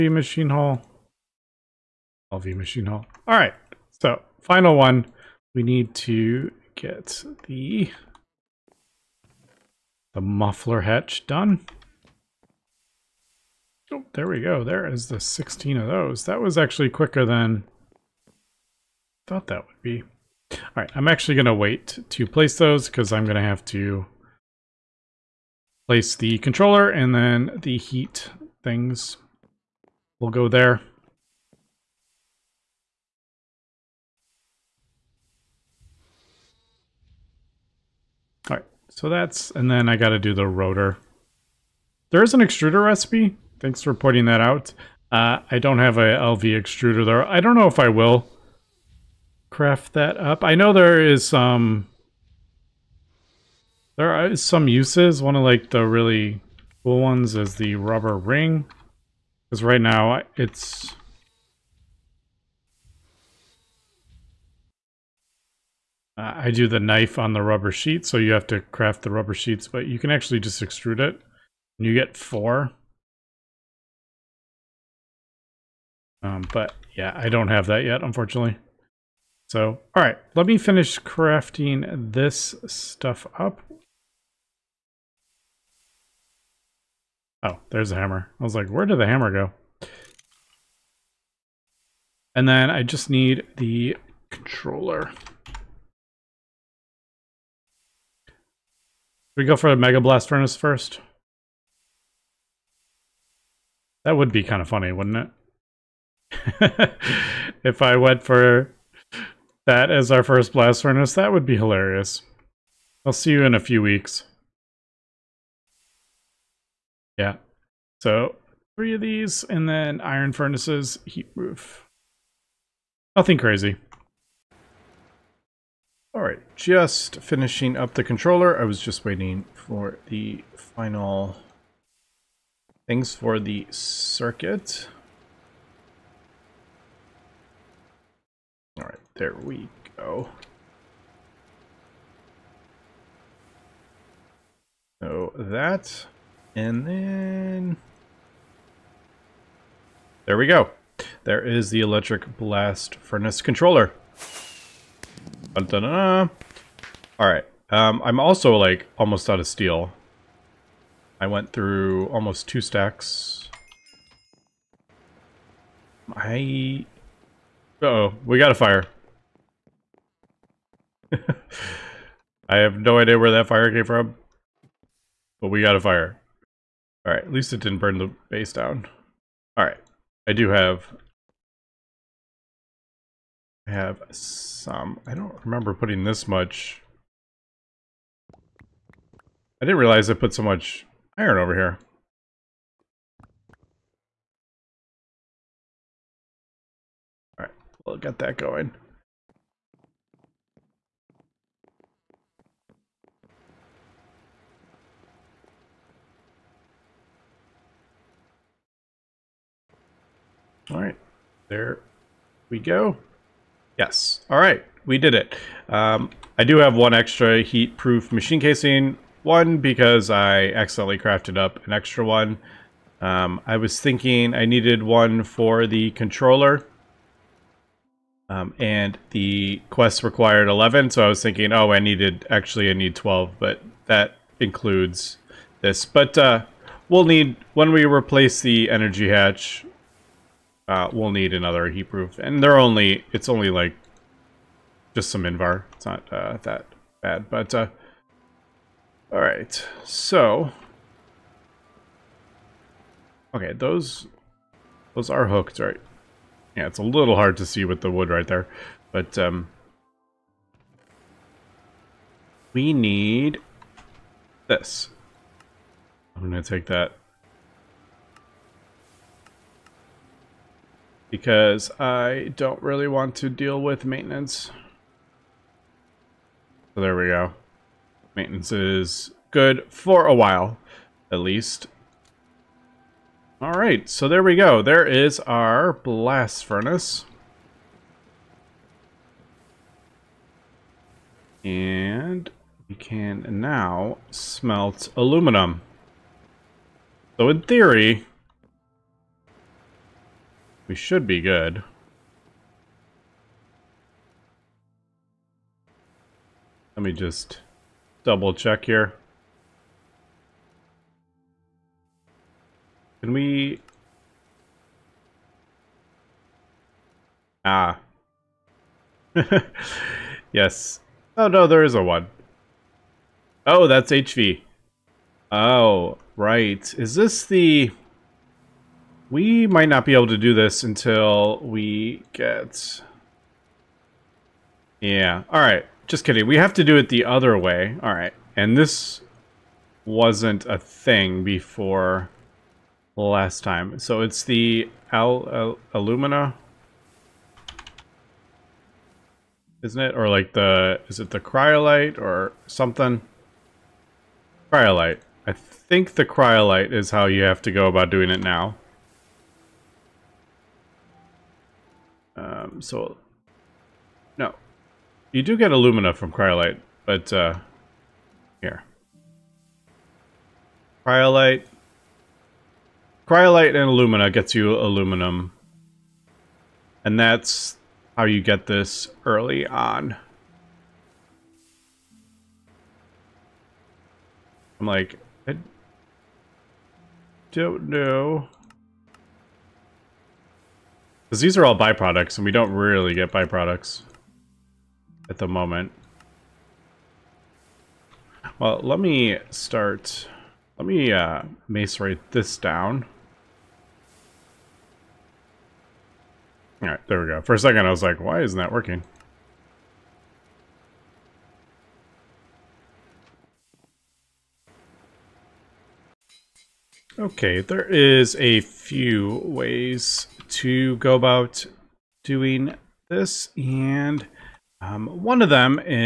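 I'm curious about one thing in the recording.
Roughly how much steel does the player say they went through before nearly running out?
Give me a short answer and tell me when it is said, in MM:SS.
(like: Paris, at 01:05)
Almost two stacks, at 02:42.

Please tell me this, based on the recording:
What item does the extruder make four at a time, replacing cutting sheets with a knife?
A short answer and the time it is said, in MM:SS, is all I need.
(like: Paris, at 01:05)
Rubber ring, at 00:57.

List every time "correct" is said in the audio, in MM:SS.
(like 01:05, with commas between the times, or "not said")
not said.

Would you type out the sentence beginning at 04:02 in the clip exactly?
And they're only, it's only like just some Invar.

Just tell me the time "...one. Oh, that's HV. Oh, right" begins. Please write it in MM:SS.
05:21.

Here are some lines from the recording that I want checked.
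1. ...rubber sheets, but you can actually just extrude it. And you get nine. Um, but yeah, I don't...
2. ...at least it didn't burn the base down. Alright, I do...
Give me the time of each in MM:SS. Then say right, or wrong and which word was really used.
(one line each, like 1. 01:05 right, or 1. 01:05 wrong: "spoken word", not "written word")
1. 01:09 wrong: "four", not "nine"
2. 02:57 right.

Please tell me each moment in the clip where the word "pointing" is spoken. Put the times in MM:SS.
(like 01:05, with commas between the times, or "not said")
00:43.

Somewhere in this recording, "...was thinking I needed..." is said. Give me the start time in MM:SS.
03:43.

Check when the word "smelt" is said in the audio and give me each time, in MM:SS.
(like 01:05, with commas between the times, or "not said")
04:54.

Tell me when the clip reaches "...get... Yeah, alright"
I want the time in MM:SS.
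05:32.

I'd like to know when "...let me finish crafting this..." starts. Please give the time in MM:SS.
01:20.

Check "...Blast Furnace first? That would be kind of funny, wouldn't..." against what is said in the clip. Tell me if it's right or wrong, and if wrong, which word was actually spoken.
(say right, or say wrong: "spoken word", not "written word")
right.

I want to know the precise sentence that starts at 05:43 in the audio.
So it's the al, al alumina, isn't it?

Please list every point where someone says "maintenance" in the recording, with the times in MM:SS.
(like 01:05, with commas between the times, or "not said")
04:33, 04:38.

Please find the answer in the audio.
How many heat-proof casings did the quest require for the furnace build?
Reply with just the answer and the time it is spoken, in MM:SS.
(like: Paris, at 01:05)
11, at 03:50.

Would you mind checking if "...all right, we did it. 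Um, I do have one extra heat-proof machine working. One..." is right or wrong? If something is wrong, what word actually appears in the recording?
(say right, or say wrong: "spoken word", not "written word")
wrong: "casing", not "working".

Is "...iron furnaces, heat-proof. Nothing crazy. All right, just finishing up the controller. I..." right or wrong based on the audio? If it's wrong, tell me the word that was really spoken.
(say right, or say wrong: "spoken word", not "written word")
right.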